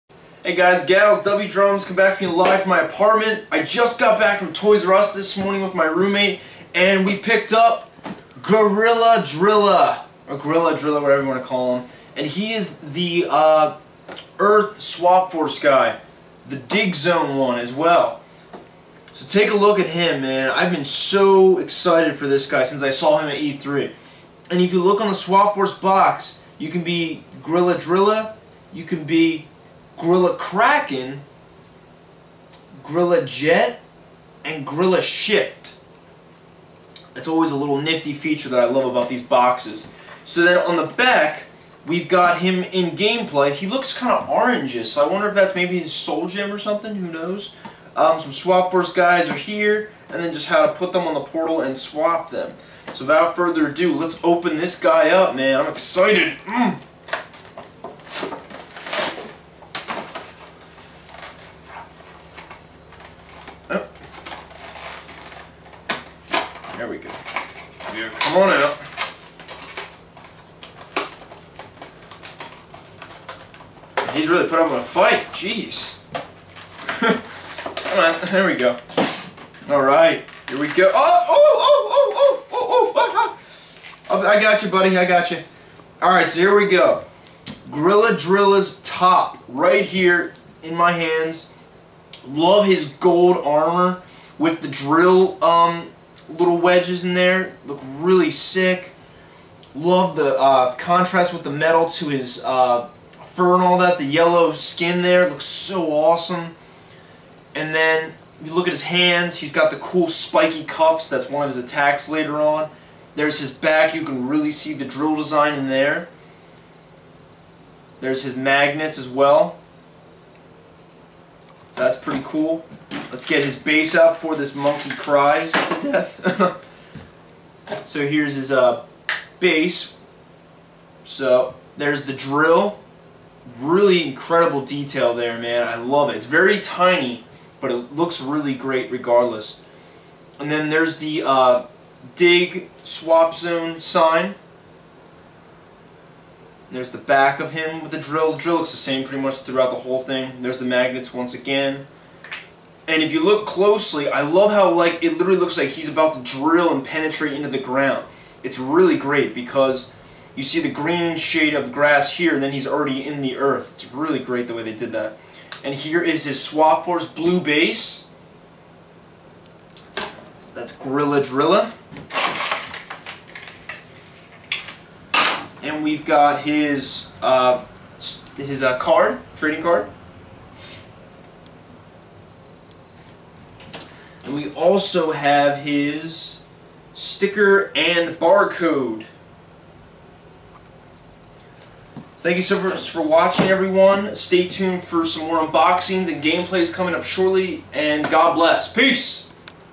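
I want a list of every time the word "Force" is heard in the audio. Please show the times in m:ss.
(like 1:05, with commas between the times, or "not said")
0:15, 0:25, 0:48, 2:46.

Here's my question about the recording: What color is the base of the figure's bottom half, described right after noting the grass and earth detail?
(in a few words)
Blue.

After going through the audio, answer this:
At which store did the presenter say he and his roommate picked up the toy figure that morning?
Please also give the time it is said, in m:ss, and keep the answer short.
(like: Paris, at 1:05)
Toys R Us, at 0:04.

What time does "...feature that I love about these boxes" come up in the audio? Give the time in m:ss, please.
0:38.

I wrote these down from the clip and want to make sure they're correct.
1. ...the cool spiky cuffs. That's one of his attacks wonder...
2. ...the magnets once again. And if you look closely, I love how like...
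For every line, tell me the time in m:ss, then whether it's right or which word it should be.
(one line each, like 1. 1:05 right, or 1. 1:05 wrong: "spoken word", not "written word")
1. 1:49 wrong: "later", not "wonder"
2. 2:30 right.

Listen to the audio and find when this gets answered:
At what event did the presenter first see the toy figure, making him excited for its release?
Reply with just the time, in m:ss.
0:23.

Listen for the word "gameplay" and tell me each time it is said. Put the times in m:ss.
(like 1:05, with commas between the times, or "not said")
0:42, 3:16.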